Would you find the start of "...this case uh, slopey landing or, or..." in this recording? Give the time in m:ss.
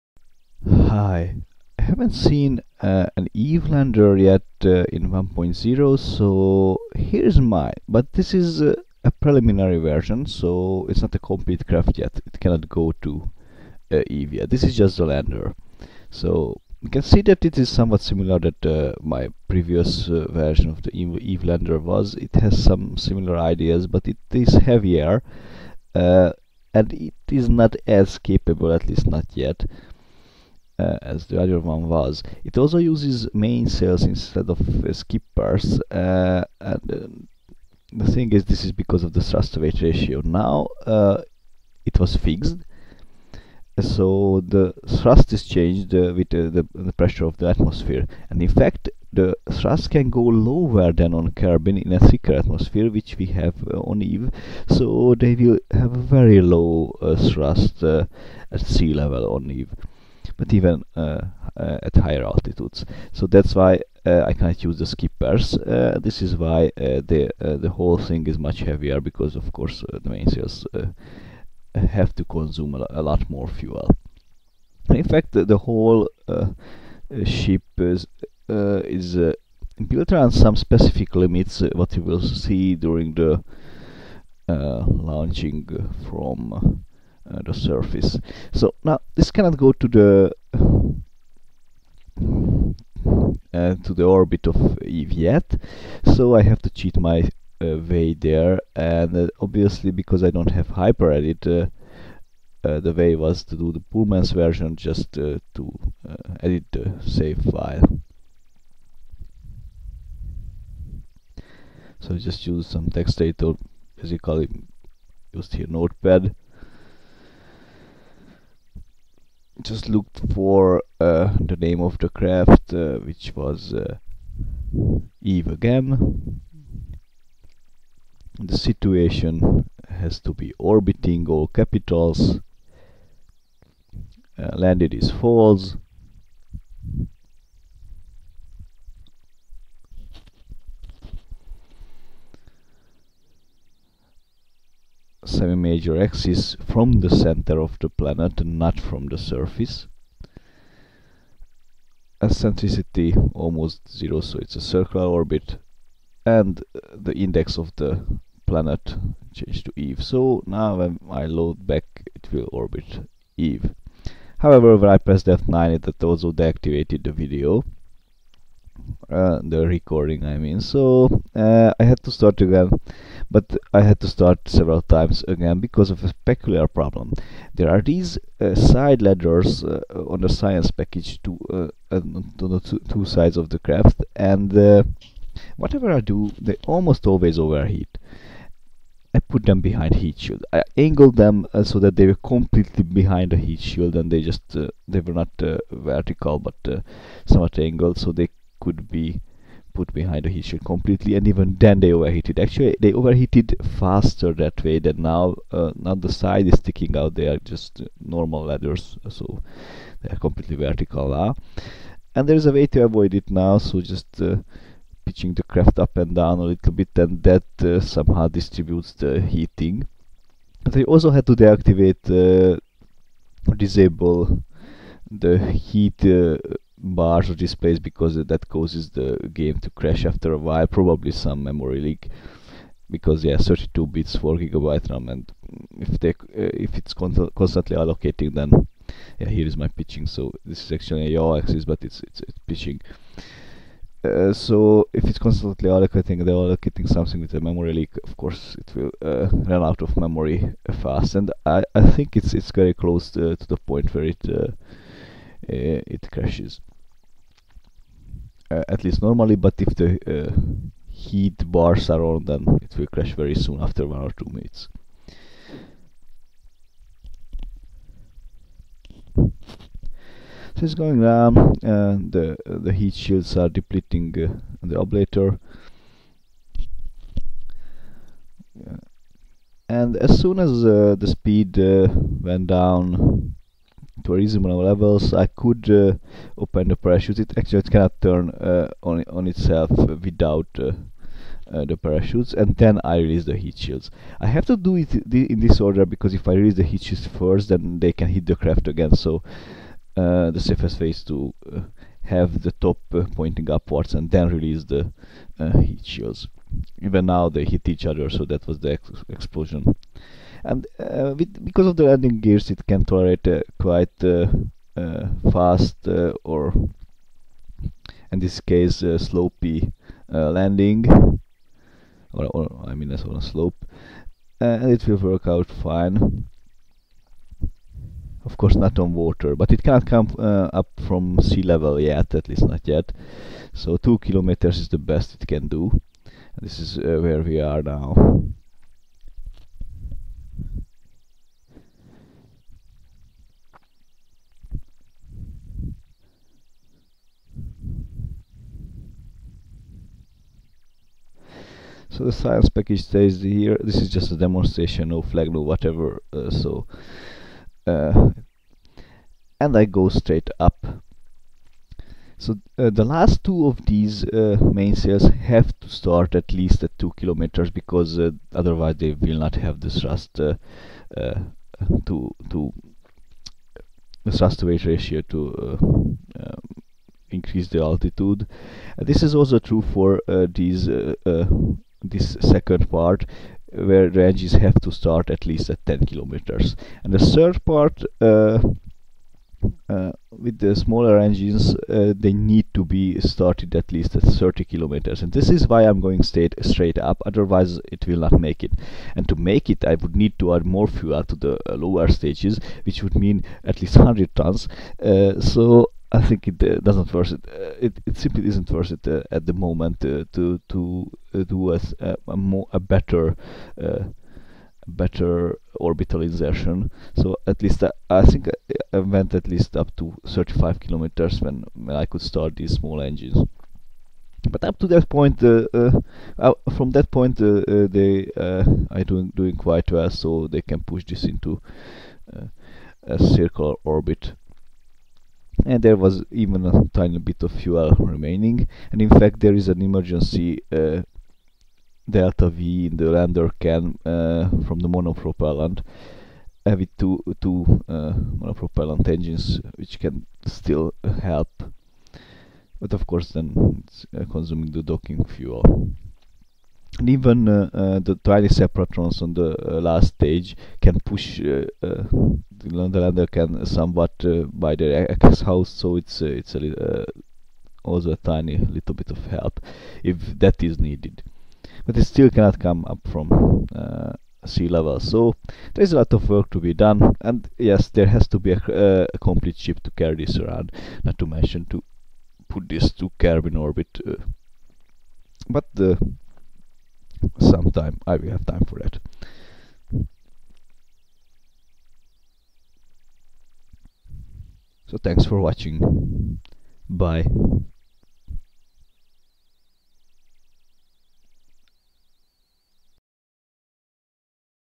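5:18.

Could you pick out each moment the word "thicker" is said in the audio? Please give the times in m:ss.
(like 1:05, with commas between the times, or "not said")
0:51.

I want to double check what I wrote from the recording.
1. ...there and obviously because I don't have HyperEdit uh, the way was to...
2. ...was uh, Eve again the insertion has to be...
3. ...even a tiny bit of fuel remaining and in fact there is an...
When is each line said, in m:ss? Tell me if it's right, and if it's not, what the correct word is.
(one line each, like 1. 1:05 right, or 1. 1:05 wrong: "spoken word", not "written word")
1. 1:38 right
2. 2:03 wrong: "situation", not "insertion"
3. 7:16 right.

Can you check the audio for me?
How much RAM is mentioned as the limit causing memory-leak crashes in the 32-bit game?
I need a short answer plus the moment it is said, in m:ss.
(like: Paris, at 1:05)
4 gigabytes, at 3:54.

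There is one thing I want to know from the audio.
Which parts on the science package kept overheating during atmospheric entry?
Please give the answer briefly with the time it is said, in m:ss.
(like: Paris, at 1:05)
side ladders, at 2:58.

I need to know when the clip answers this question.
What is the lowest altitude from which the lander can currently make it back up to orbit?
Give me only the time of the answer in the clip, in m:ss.
5:33.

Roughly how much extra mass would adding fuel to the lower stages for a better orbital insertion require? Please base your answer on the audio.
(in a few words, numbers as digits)
100 tons.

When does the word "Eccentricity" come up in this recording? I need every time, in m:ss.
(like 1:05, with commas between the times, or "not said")
2:32.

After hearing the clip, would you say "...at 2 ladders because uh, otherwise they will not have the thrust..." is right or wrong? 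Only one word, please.
wrong.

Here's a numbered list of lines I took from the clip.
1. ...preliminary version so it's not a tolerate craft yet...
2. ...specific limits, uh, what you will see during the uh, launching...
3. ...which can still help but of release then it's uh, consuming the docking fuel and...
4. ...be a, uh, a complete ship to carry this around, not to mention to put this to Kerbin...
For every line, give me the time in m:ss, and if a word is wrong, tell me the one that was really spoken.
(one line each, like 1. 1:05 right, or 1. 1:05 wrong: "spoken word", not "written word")
1. 0:09 wrong: "complete", not "tolerate"
2. 1:20 right
3. 7:29 wrong: "course", not "release"
4. 7:58 right.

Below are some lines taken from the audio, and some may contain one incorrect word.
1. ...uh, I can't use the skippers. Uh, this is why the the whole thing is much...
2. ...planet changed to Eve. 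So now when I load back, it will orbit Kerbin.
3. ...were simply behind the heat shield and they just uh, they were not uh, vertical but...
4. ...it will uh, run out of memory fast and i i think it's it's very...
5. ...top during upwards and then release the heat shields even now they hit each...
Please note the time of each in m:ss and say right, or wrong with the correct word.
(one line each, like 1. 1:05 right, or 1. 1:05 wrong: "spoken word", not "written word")
1. 1:04 right
2. 2:38 wrong: "Eve", not "Kerbin"
3. 3:12 wrong: "completely", not "simply"
4. 4:08 right
5. 5:02 wrong: "pointing", not "during".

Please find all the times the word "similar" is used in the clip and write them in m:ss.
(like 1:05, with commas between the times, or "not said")
0:18, 0:22.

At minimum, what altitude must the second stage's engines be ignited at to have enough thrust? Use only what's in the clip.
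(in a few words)
10 kilometers.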